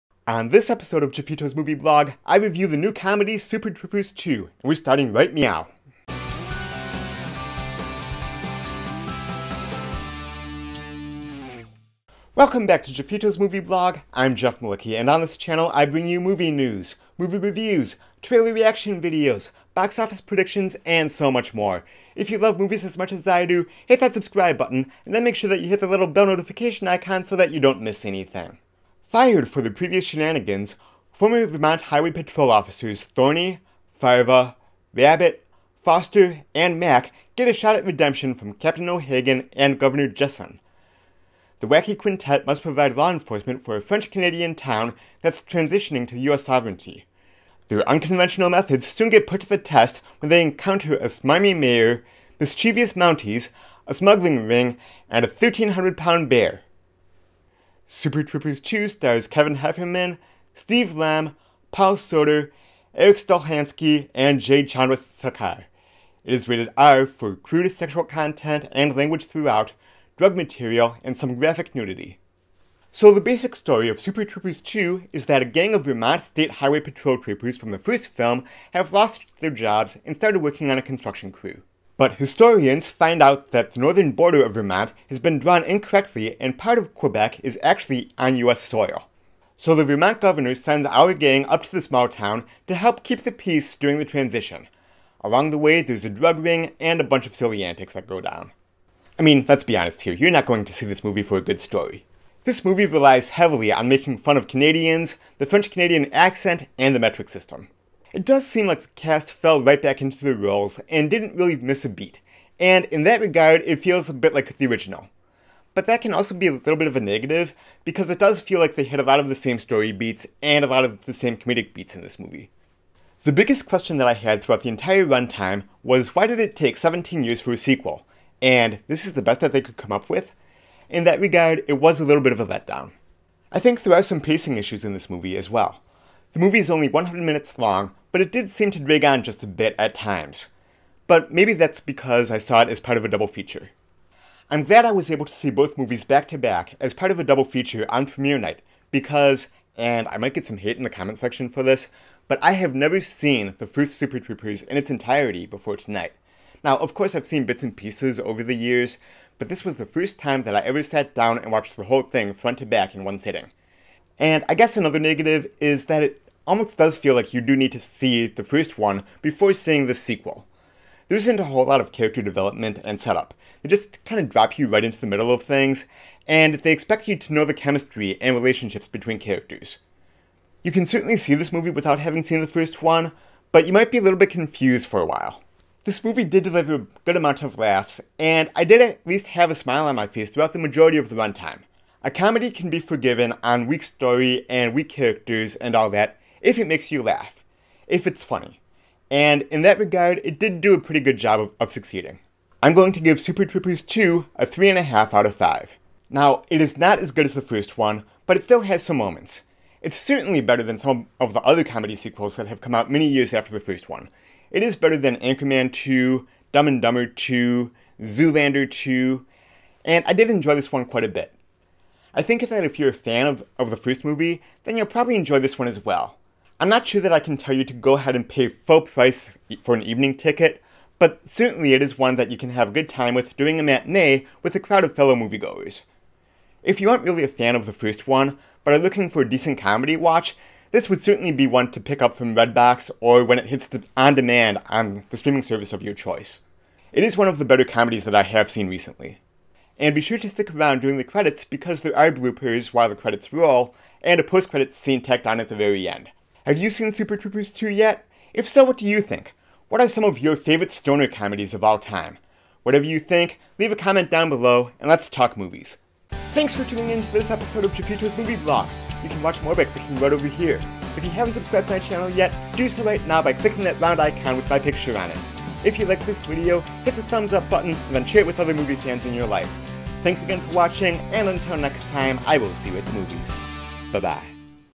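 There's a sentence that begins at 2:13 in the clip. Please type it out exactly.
I think there are some pacing issues in this movie as well.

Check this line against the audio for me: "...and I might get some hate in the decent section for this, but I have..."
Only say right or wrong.
wrong.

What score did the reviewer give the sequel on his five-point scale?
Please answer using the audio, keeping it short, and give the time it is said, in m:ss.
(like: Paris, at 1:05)
3.5, at 3:24.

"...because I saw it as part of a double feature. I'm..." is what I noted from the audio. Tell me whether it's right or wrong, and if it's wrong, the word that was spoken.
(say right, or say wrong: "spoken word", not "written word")
right.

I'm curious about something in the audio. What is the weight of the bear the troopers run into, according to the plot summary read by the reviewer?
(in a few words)
1,300 pounds.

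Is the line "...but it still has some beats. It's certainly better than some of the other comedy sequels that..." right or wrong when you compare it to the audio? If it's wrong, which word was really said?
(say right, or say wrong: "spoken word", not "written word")
wrong: "moments", not "beats".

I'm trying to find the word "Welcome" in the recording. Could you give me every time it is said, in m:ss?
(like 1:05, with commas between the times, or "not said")
0:12.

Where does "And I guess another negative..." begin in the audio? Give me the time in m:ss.
2:44.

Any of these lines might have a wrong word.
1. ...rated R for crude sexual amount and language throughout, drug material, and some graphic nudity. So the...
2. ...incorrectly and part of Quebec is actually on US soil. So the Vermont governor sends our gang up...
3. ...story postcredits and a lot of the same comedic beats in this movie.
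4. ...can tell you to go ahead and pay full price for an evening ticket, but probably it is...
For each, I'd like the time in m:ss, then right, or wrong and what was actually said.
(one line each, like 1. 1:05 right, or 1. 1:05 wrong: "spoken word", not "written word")
1. 1:06 wrong: "content", not "amount"
2. 1:25 right
3. 1:59 wrong: "beats", not "postcredits"
4. 3:47 wrong: "certainly", not "probably".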